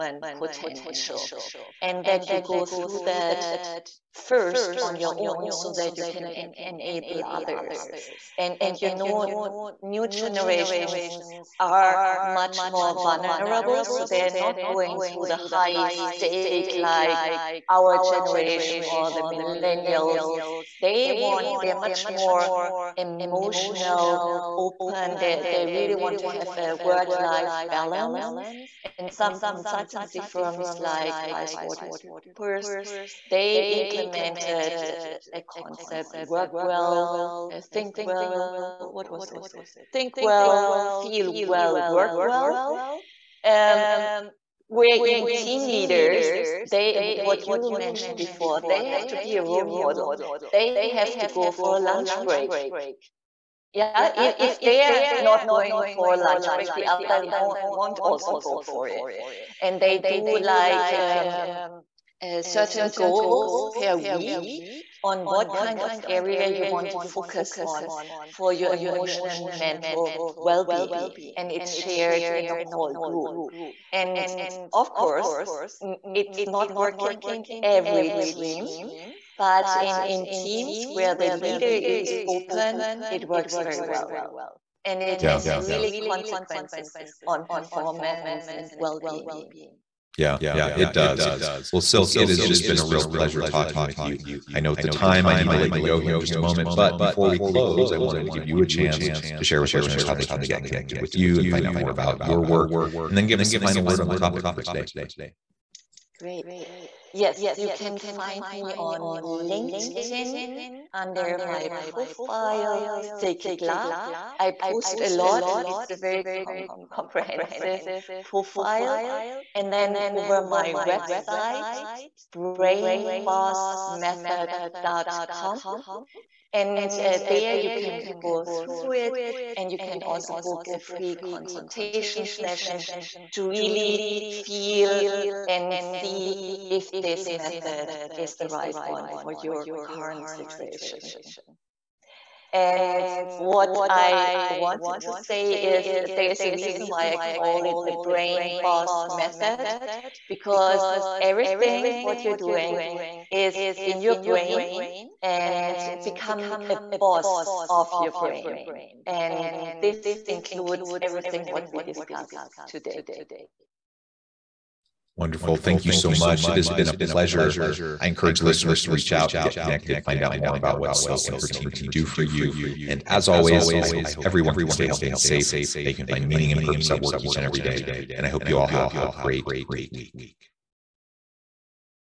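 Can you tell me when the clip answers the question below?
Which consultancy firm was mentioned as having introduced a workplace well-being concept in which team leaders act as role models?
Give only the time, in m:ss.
0:31.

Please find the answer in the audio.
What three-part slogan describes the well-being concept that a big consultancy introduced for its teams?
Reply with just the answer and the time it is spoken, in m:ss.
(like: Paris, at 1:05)
Think well, feel well, work well, at 0:39.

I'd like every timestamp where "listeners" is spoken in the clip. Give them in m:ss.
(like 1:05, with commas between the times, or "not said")
1:39, 2:48.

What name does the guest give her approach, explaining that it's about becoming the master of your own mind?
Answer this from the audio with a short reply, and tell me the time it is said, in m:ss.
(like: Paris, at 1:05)
BrainBoss method, at 2:28.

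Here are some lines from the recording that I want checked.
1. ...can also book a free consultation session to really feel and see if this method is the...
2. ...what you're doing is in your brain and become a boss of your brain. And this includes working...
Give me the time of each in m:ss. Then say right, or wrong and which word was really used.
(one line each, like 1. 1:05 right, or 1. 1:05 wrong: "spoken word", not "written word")
1. 2:09 right
2. 2:31 wrong: "everything", not "working".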